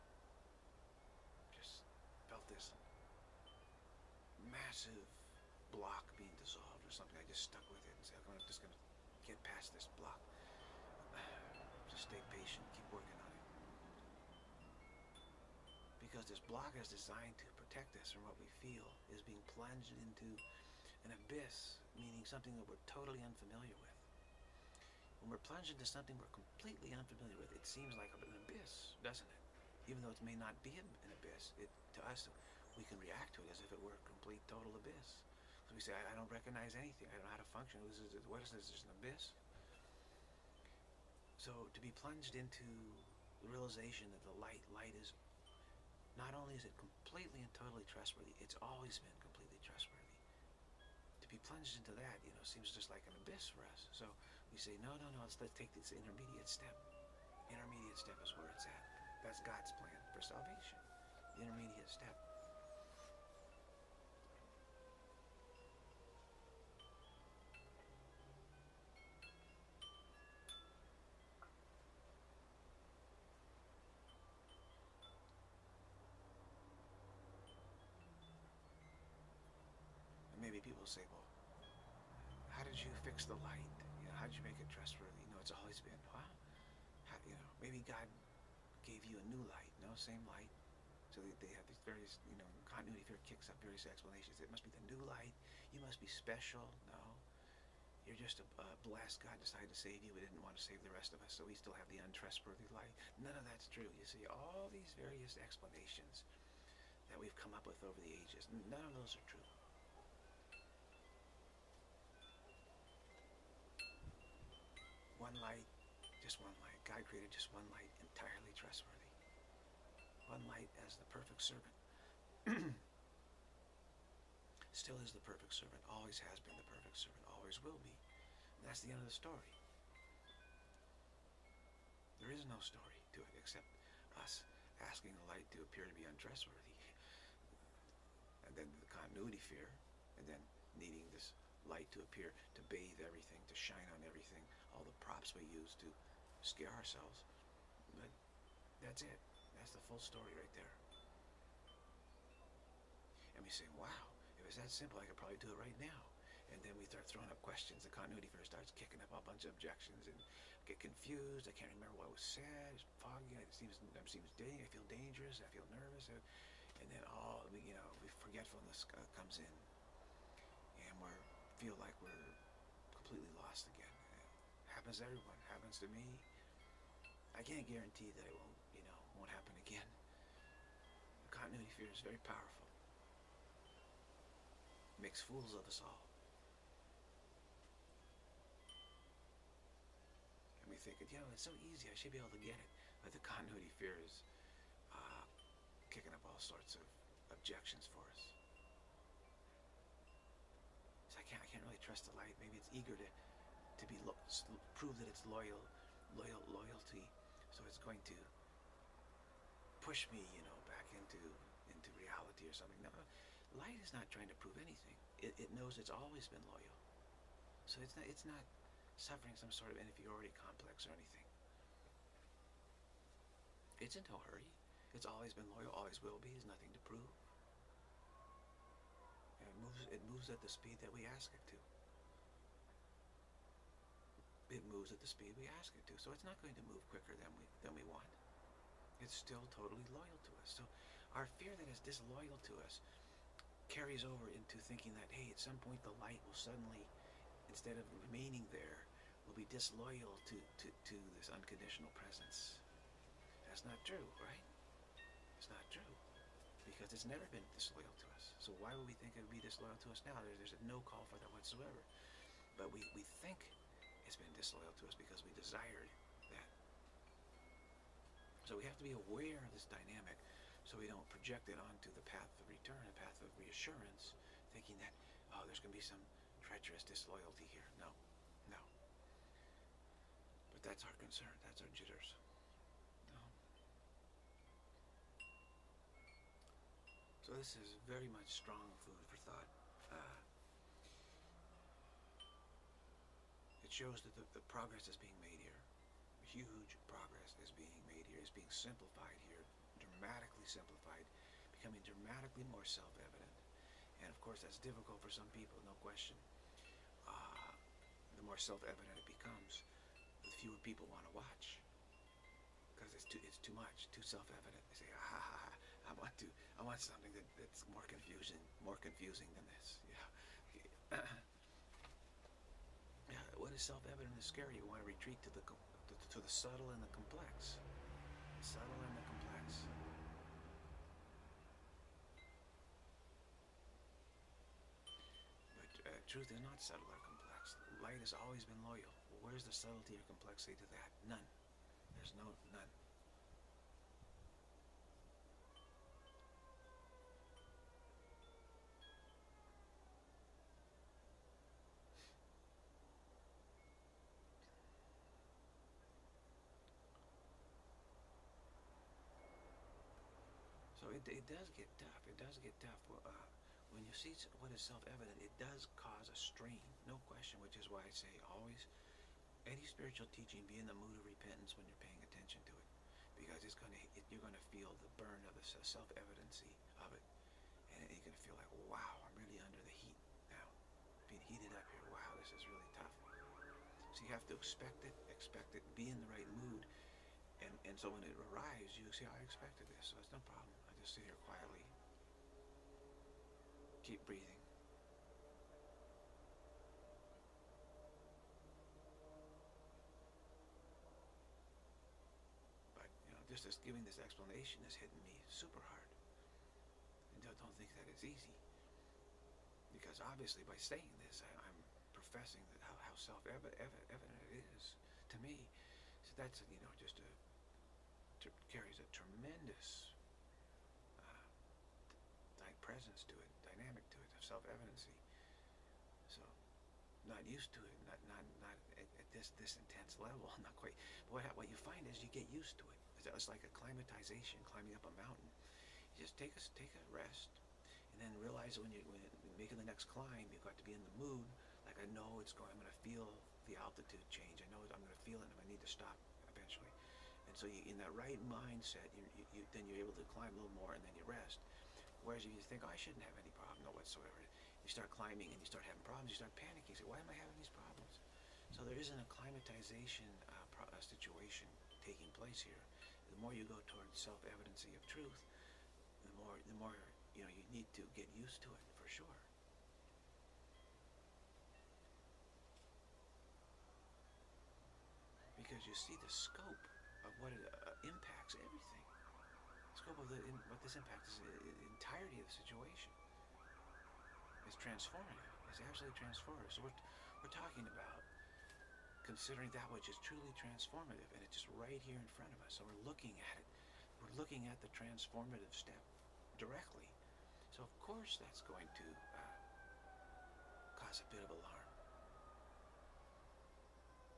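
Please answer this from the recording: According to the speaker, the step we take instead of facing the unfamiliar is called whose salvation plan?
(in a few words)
God's plan.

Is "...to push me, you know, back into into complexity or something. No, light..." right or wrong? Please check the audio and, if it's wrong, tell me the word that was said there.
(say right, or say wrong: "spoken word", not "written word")
wrong: "reality", not "complexity".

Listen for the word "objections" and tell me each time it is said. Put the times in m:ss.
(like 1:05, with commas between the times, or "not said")
2:39, 3:17.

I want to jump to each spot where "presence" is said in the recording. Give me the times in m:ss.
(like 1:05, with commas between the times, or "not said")
4:11, 7:02.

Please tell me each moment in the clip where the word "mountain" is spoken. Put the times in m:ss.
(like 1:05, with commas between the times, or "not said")
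7:14.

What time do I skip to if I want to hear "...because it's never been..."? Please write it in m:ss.
4:16.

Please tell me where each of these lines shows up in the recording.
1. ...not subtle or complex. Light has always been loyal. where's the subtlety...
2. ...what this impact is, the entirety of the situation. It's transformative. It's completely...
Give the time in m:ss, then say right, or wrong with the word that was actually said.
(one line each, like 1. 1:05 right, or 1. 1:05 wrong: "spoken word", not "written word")
1. 5:36 right
2. 8:00 wrong: "absolutely", not "completely".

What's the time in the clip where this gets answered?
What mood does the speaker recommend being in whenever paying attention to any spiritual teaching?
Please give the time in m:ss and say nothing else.
6:11.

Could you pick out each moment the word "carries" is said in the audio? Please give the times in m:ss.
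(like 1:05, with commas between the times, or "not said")
4:03, 6:58.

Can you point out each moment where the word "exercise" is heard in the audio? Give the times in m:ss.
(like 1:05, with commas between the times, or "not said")
not said.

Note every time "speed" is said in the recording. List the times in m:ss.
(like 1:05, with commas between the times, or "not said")
3:50, 3:55.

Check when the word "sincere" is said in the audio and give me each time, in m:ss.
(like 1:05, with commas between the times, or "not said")
not said.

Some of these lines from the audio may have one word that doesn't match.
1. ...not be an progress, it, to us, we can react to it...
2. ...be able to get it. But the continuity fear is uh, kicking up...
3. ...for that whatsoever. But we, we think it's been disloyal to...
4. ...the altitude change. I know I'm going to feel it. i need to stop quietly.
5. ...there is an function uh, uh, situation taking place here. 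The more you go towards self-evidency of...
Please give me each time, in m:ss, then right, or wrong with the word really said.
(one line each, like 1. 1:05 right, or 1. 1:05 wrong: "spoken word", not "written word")
1. 0:30 wrong: "abyss", not "progress"
2. 3:12 right
3. 4:21 right
4. 7:23 wrong: "eventually", not "quietly"
5. 7:38 wrong: "acclimatization", not "function".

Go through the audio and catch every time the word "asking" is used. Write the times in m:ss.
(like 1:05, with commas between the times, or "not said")
2:14.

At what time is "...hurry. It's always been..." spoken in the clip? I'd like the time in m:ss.
3:44.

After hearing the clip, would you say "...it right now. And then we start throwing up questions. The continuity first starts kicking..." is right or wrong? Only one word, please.
right.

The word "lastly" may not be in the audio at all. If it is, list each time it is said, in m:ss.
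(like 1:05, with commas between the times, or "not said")
not said.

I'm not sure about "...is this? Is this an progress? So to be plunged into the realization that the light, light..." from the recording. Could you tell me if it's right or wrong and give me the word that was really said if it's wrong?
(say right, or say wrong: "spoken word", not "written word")
wrong: "abyss", not "progress".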